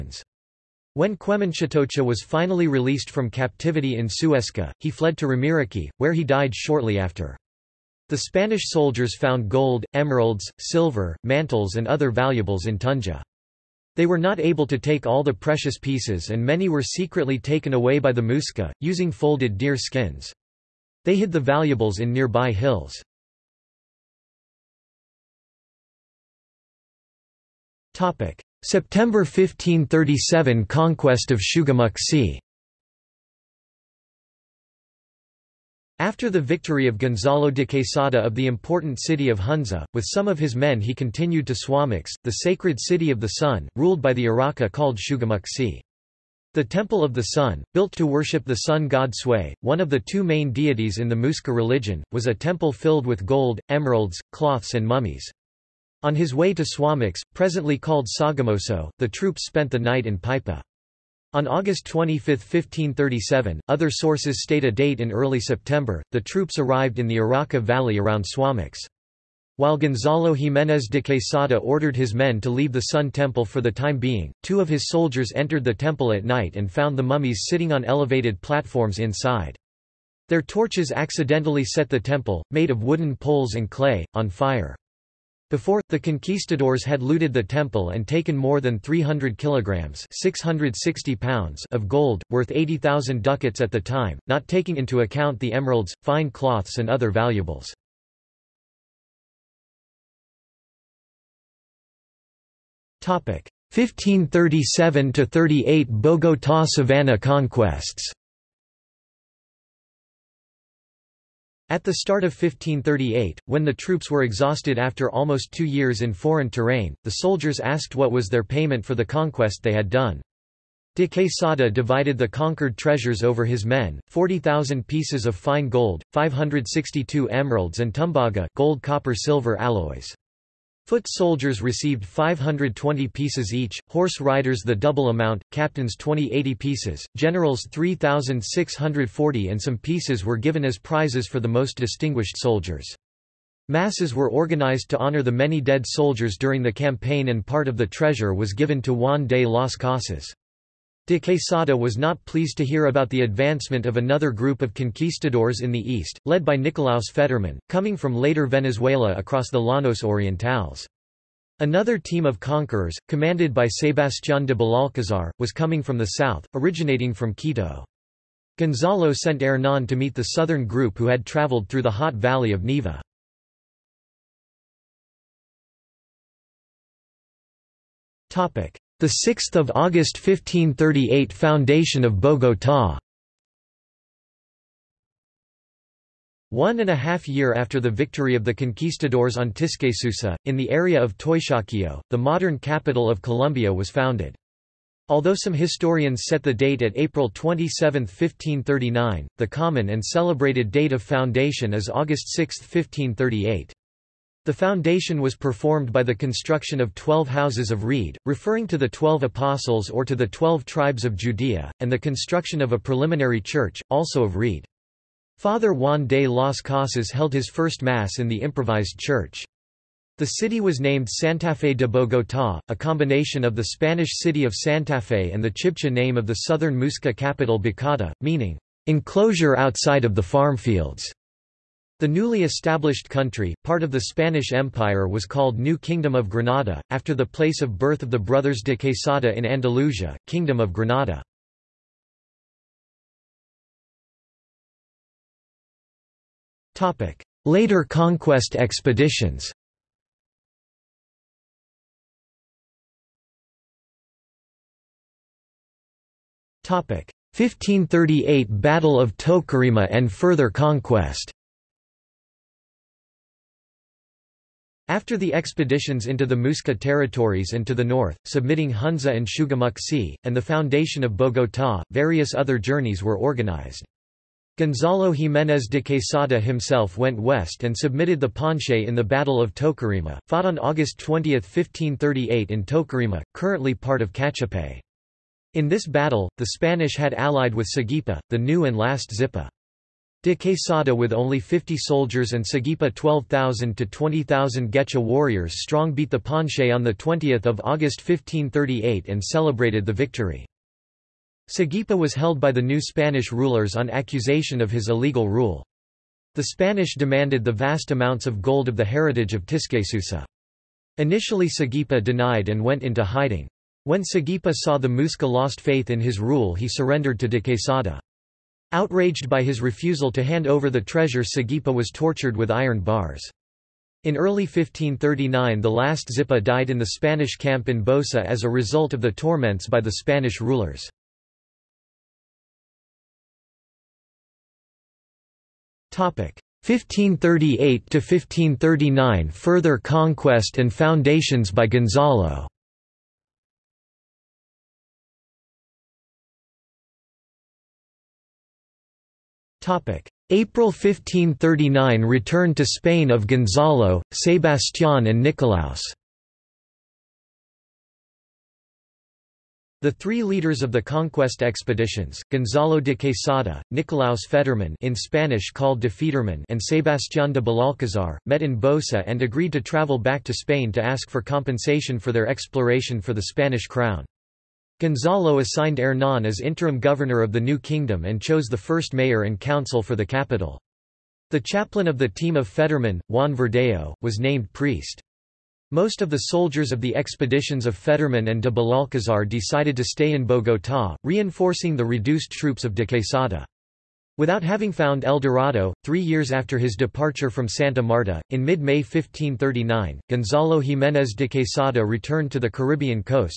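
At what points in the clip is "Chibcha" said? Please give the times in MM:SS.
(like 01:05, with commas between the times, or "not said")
03:45.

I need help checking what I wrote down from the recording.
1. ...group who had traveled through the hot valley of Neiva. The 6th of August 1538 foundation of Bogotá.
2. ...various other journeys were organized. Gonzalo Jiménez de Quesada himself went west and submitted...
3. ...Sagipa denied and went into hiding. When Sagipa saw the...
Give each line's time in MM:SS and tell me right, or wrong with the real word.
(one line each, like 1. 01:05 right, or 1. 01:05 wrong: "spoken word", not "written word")
1. 02:50 right
2. 04:31 right
3. 05:11 right.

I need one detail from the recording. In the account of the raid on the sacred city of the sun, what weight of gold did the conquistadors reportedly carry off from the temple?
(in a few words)
300 kilograms.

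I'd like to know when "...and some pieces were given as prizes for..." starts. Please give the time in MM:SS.
02:19.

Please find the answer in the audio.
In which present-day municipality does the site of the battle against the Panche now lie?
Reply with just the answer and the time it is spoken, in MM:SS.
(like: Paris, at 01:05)
Cachipay, at 04:44.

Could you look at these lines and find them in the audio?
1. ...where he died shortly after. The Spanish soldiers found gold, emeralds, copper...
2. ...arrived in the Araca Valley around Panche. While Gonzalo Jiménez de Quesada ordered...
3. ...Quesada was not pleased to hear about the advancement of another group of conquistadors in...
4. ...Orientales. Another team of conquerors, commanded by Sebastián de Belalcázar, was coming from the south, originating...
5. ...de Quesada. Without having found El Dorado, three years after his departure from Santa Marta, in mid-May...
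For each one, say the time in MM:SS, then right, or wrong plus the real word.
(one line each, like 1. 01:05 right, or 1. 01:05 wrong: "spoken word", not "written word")
1. 00:05 wrong: "silver", not "copper"
2. 01:06 wrong: "Suamox", not "Panche"
3. 02:31 right
4. 02:40 right
5. 06:32 right.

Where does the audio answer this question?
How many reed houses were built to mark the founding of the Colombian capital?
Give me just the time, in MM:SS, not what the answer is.
03:26.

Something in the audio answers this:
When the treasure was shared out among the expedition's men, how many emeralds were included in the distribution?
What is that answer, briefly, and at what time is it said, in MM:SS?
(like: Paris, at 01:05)
562, at 02:06.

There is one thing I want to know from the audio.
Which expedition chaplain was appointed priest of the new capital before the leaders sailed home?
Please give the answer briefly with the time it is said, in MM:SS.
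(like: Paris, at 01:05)
Juan Verdeo, at 06:23.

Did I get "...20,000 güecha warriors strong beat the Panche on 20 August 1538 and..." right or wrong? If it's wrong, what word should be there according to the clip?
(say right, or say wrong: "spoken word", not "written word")
right.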